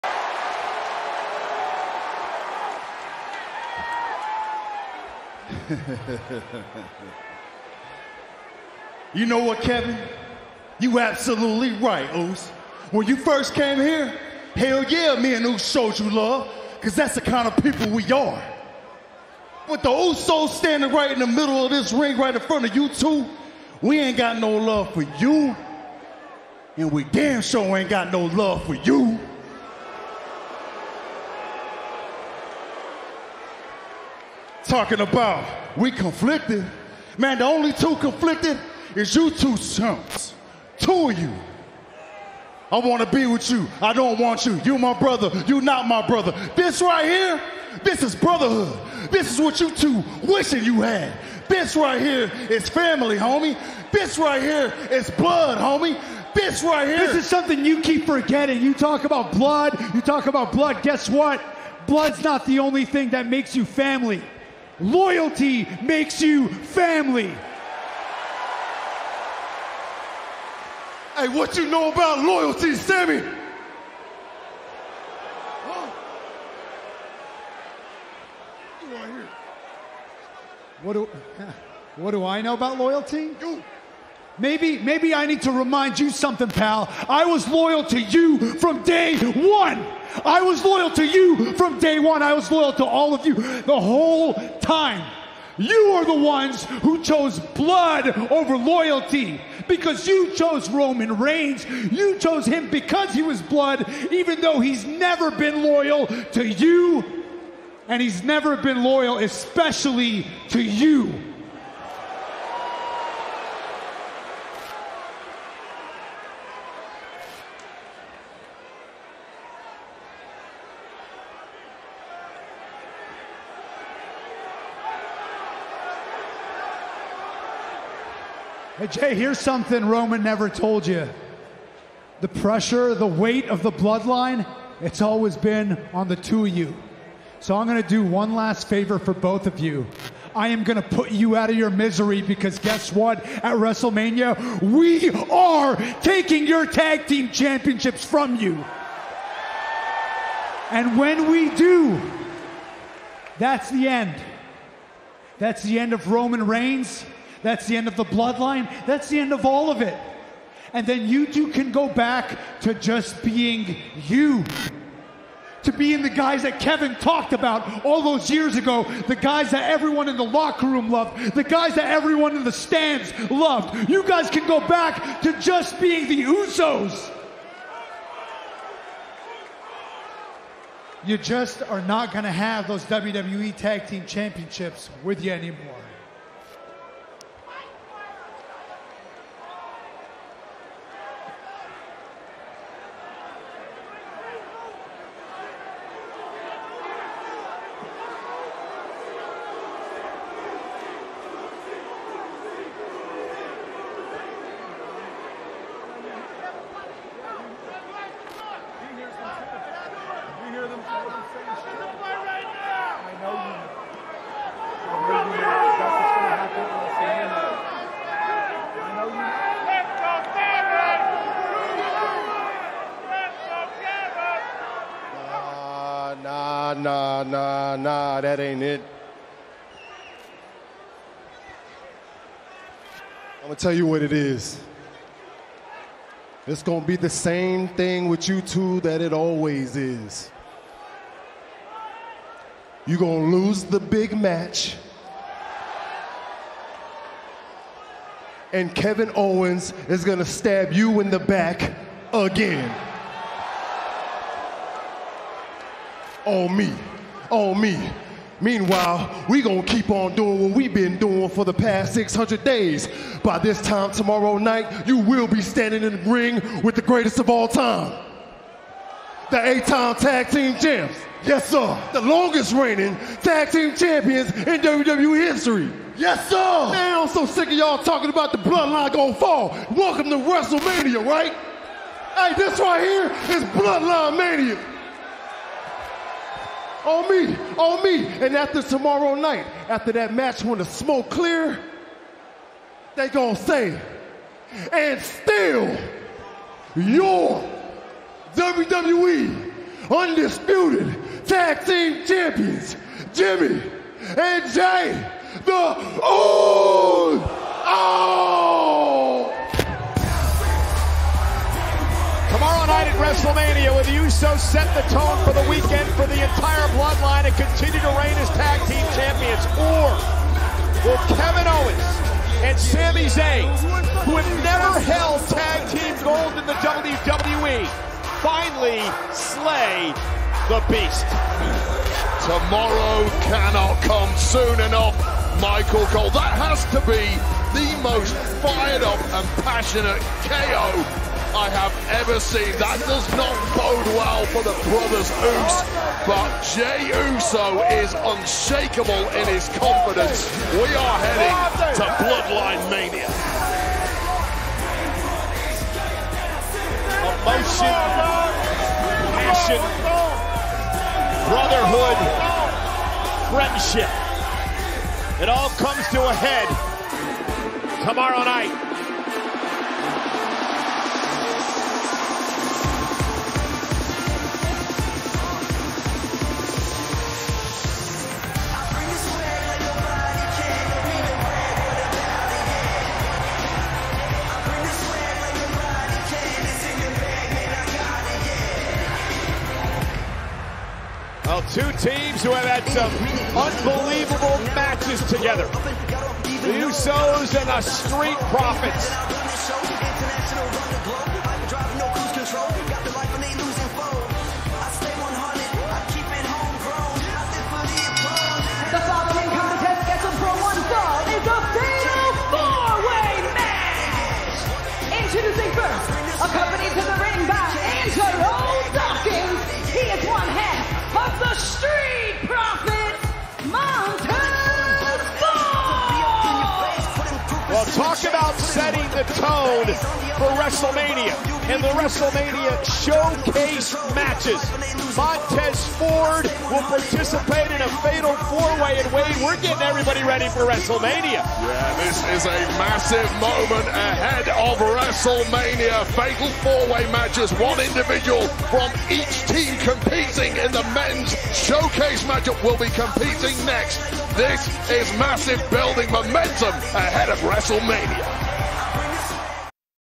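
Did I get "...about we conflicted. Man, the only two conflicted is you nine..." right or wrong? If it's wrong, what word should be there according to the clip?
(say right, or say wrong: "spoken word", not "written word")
wrong: "two", not "nine".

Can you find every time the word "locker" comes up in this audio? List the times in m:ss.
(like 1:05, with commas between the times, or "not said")
2:50.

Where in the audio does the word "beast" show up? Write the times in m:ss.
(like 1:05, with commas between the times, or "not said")
5:30.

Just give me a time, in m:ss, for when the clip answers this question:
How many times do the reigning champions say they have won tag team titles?
4:29.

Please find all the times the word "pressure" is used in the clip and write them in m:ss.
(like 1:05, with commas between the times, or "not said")
2:12.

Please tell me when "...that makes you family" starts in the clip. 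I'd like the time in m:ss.
1:03.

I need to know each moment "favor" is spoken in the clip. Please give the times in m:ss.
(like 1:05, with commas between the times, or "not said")
2:18.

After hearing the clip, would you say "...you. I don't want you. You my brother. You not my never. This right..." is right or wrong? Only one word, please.
wrong.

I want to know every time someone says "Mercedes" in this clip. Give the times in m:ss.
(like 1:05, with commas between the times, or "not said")
not said.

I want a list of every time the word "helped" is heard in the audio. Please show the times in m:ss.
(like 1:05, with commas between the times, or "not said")
not said.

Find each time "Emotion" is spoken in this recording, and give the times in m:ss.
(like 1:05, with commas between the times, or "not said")
5:57.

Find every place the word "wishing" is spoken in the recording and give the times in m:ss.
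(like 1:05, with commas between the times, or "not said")
0:50.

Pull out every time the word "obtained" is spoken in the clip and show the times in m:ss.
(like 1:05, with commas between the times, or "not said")
not said.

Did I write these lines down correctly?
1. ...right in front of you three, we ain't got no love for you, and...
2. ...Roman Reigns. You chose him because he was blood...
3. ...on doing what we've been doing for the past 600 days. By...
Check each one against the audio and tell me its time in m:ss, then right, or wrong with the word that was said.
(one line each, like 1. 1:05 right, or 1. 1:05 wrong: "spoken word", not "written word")
1. 0:22 wrong: "two", not "three"
2. 1:40 right
3. 4:19 right.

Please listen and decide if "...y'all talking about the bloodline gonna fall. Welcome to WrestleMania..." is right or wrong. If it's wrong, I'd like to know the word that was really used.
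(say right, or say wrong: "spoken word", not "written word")
right.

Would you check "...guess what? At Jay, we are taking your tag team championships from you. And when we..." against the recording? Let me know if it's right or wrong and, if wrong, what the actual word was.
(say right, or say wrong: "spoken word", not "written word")
wrong: "WrestleMania", not "Jay".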